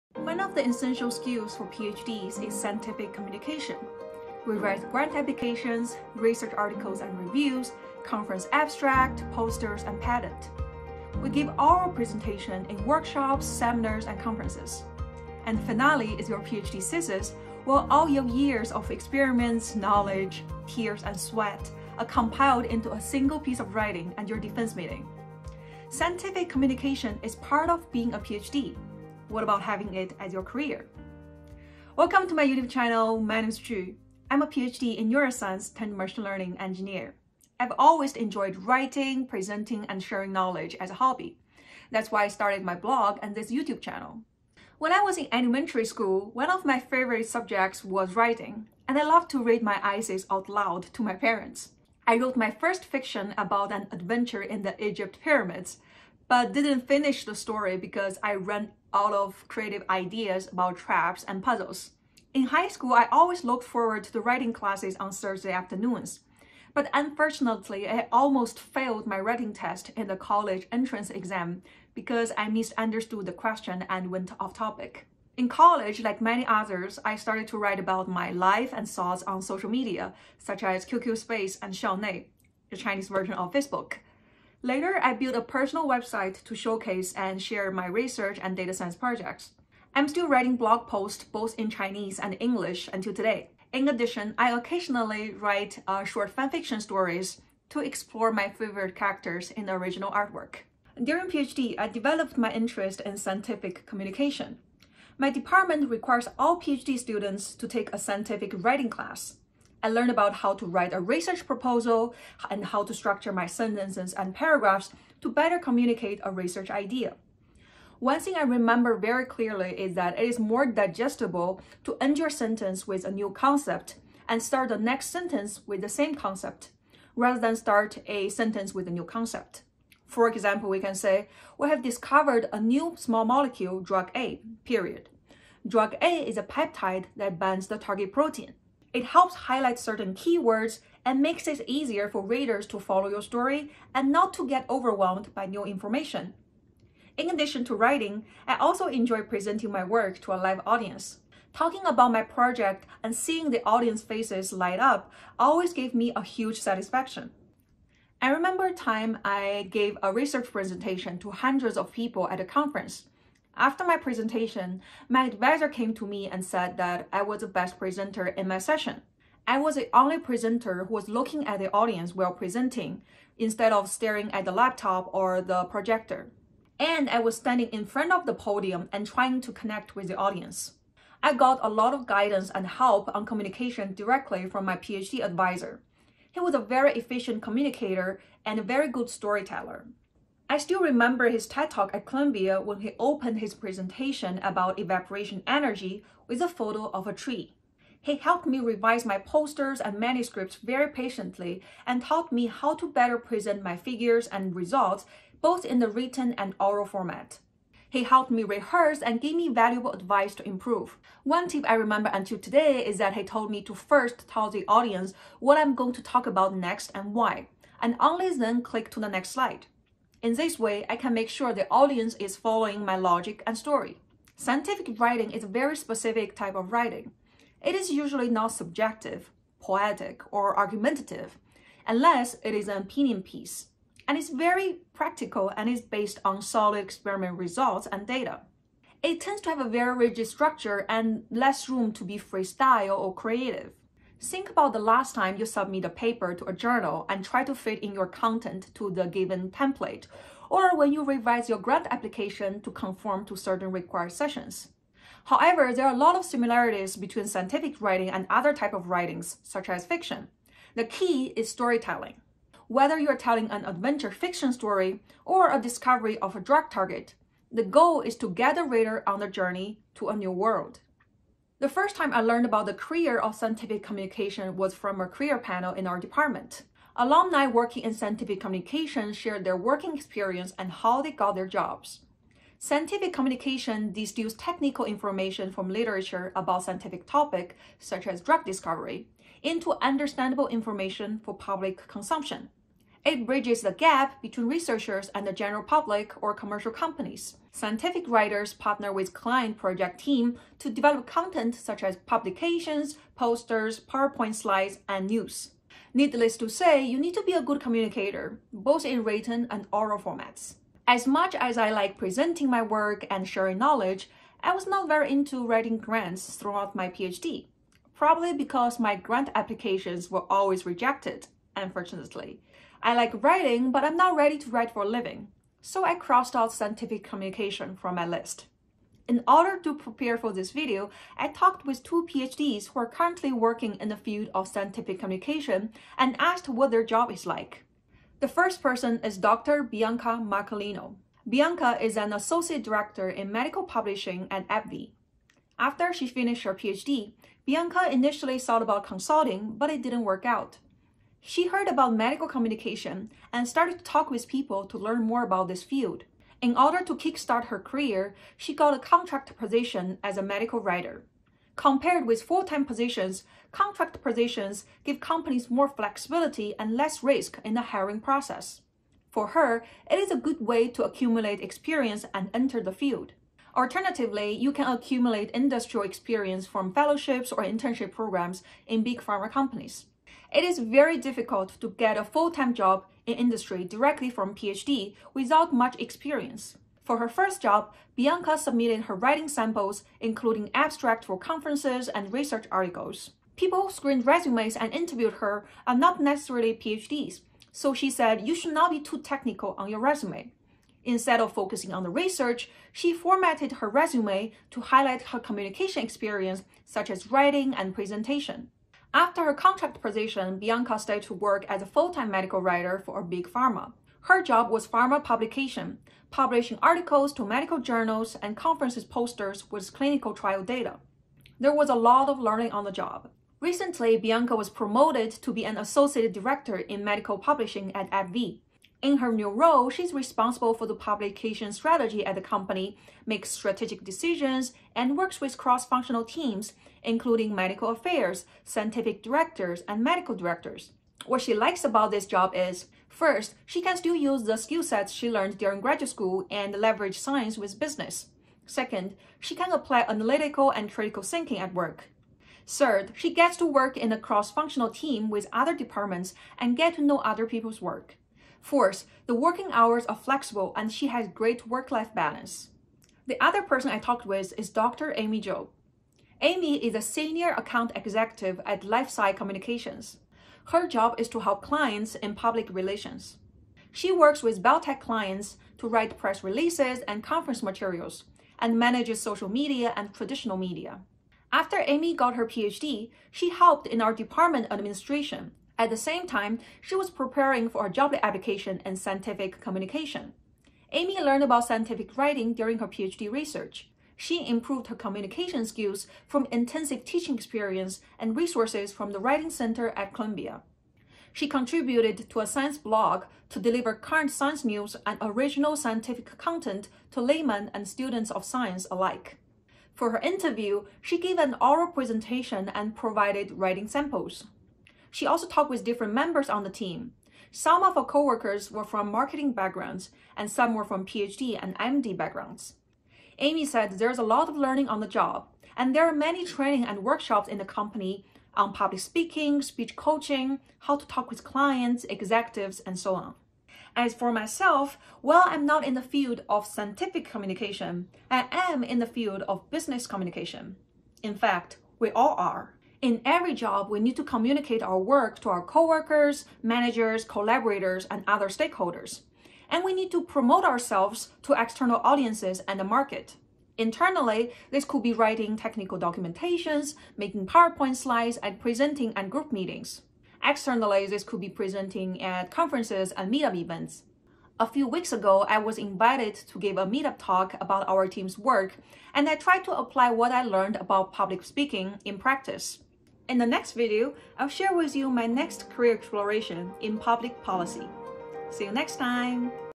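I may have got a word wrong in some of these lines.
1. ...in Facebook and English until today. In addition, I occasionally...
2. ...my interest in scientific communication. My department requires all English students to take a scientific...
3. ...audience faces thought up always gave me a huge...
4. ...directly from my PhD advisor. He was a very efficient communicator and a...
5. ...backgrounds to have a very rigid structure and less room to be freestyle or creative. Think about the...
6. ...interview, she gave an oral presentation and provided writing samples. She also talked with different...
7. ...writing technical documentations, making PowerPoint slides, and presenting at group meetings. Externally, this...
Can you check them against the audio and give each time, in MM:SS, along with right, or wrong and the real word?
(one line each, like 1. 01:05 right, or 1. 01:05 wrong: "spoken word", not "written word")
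1. 01:31 wrong: "Chinese", not "Facebook"
2. 01:42 wrong: "PhD", not "English"
3. 02:33 wrong: "light", not "thought"
4. 03:03 right
5. 03:59 wrong: "tends", not "backgrounds"
6. 08:29 right
7. 09:14 right.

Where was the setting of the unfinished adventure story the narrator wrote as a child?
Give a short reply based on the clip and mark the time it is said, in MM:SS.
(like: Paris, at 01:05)
Egypt pyramids, at 00:54.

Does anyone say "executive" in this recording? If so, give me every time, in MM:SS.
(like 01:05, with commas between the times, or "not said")
07:47, 08:51.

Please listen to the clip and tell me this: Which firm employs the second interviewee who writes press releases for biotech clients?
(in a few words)
LifeSci Communications.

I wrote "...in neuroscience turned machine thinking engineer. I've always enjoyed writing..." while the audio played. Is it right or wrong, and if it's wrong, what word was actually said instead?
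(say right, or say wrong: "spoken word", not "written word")
wrong: "learning", not "thinking".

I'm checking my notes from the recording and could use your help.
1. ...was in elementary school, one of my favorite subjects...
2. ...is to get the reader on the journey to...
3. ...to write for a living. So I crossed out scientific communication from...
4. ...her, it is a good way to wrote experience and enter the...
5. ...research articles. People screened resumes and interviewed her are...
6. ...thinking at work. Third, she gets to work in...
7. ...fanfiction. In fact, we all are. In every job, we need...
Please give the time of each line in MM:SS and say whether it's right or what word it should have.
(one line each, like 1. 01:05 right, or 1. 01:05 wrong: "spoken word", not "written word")
1. 00:44 right
2. 04:28 right
3. 05:24 right
4. 06:09 wrong: "accumulate", not "wrote"
5. 06:32 right
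6. 07:31 right
7. 08:59 wrong: "communication", not "fanfiction".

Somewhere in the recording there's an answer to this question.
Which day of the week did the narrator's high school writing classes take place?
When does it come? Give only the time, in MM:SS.
01:05.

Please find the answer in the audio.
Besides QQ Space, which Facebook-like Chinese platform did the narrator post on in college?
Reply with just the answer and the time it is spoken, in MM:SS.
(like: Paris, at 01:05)
Xiaonei, at 01:21.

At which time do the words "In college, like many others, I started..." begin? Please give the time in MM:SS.
01:15.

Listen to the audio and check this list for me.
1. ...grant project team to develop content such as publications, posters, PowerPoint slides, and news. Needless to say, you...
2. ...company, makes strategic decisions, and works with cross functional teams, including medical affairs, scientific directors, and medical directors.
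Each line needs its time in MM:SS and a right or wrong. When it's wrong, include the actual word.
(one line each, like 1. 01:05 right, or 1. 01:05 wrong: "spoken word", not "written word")
1. 04:59 wrong: "client", not "grant"
2. 07:12 right.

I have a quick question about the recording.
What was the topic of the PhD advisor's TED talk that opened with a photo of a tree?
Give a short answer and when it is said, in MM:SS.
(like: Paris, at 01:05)
evaporation energy, at 03:14.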